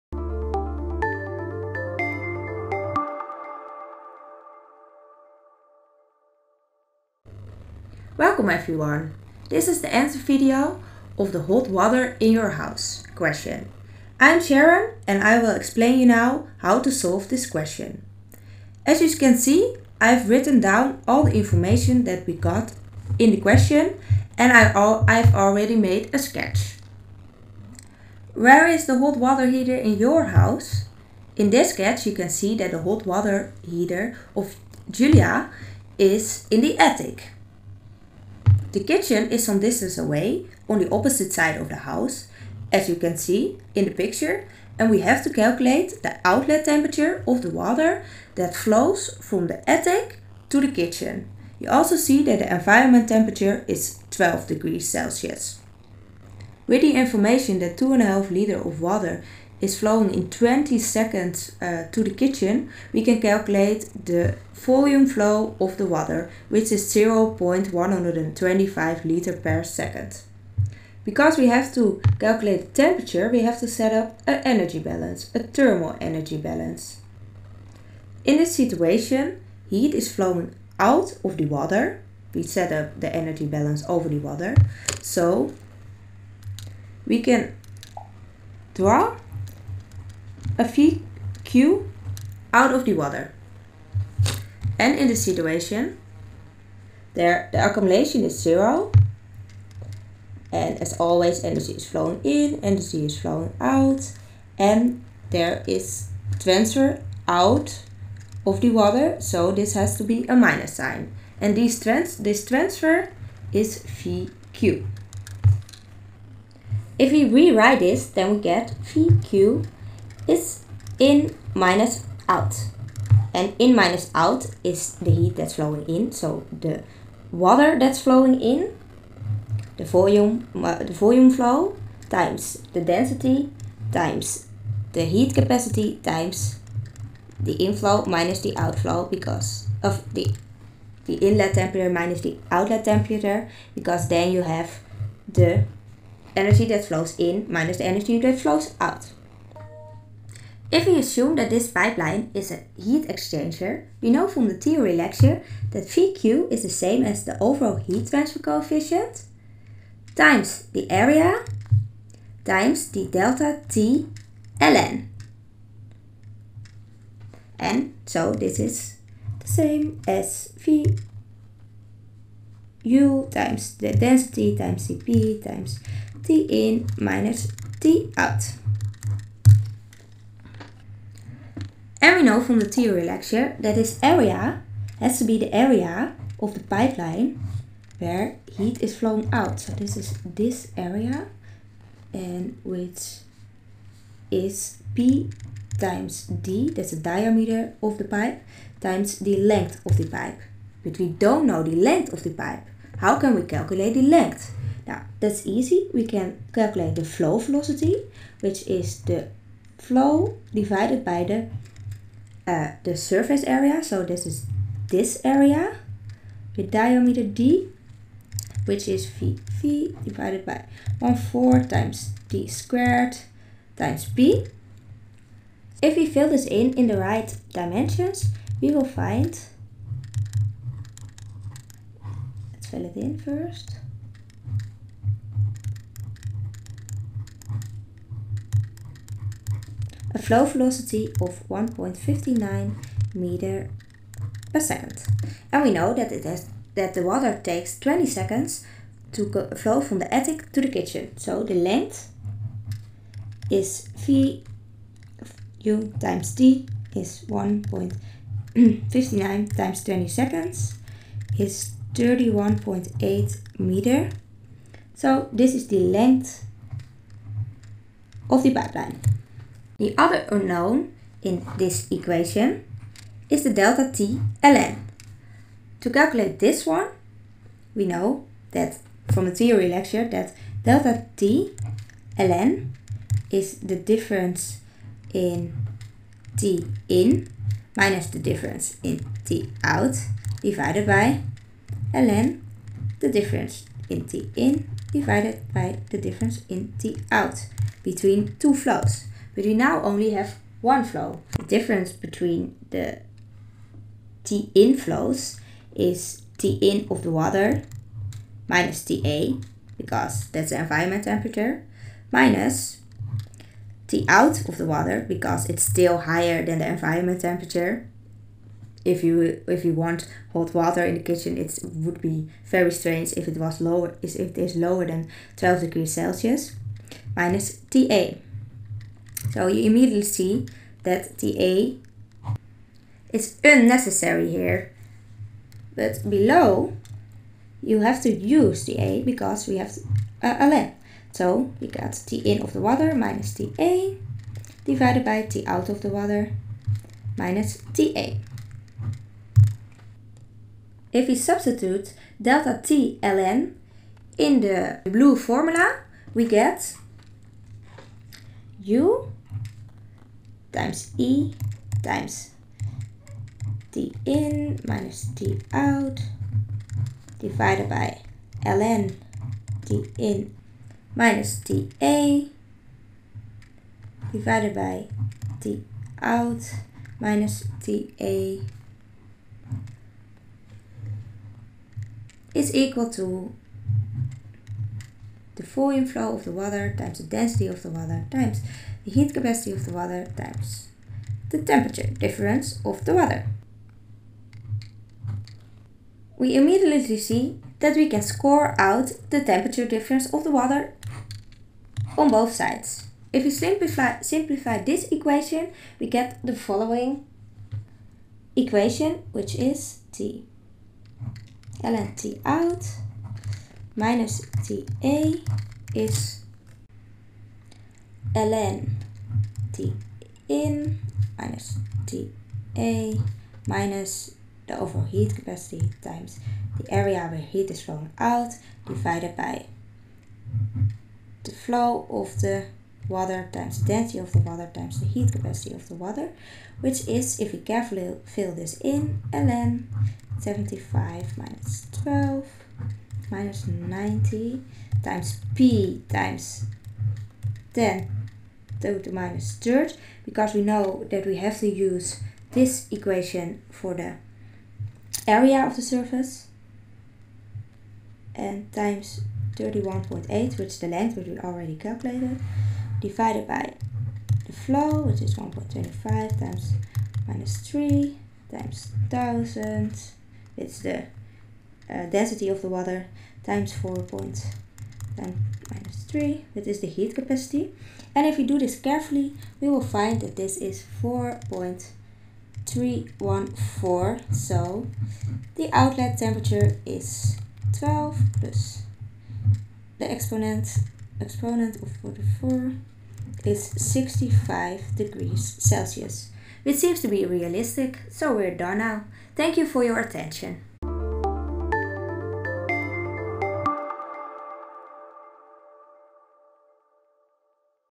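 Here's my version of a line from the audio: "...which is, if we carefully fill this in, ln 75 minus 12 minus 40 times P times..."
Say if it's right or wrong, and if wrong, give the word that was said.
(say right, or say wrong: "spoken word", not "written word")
wrong: "90", not "40".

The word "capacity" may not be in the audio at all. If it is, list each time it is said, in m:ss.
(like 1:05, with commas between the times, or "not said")
2:15, 6:29, 7:05, 7:15, 7:56.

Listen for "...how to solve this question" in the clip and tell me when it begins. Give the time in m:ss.
0:16.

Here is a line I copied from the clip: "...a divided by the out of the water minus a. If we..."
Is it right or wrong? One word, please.
right.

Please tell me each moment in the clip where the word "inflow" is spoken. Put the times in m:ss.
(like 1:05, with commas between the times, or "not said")
2:17, 6:25.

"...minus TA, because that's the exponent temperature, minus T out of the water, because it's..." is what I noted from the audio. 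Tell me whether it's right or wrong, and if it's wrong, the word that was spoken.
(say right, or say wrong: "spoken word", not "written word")
wrong: "environment", not "exponent".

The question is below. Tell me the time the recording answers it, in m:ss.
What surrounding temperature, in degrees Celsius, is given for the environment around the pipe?
0:54.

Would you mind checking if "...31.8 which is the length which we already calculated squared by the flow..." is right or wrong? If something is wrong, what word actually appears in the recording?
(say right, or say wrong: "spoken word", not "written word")
wrong: "divided", not "squared".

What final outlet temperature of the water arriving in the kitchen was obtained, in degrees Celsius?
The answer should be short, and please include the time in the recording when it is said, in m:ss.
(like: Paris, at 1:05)
65, at 8:13.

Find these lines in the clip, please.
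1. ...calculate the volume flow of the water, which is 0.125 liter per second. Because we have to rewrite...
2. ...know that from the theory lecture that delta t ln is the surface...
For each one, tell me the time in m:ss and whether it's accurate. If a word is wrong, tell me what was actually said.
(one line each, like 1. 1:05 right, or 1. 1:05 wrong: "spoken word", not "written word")
1. 1:03 wrong: "calculate", not "rewrite"
2. 4:37 wrong: "difference", not "surface".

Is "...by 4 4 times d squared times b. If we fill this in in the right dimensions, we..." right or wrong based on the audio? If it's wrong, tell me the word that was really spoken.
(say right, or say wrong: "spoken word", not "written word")
wrong: "1", not "4".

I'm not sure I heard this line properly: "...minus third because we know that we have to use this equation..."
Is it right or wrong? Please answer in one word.
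right.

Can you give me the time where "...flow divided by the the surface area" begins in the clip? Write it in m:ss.
3:29.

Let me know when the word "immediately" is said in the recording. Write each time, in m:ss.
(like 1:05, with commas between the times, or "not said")
5:29, 6:36.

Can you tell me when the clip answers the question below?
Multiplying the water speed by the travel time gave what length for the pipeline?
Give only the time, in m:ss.
4:21.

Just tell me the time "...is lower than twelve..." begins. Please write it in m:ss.
5:24.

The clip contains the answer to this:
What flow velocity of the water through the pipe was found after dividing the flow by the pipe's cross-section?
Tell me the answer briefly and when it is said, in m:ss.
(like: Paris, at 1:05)
1.59 meter per second, at 4:01.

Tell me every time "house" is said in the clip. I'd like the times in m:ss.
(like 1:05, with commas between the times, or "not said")
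0:12, 0:30, 0:41.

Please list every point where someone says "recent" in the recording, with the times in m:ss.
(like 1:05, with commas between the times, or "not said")
not said.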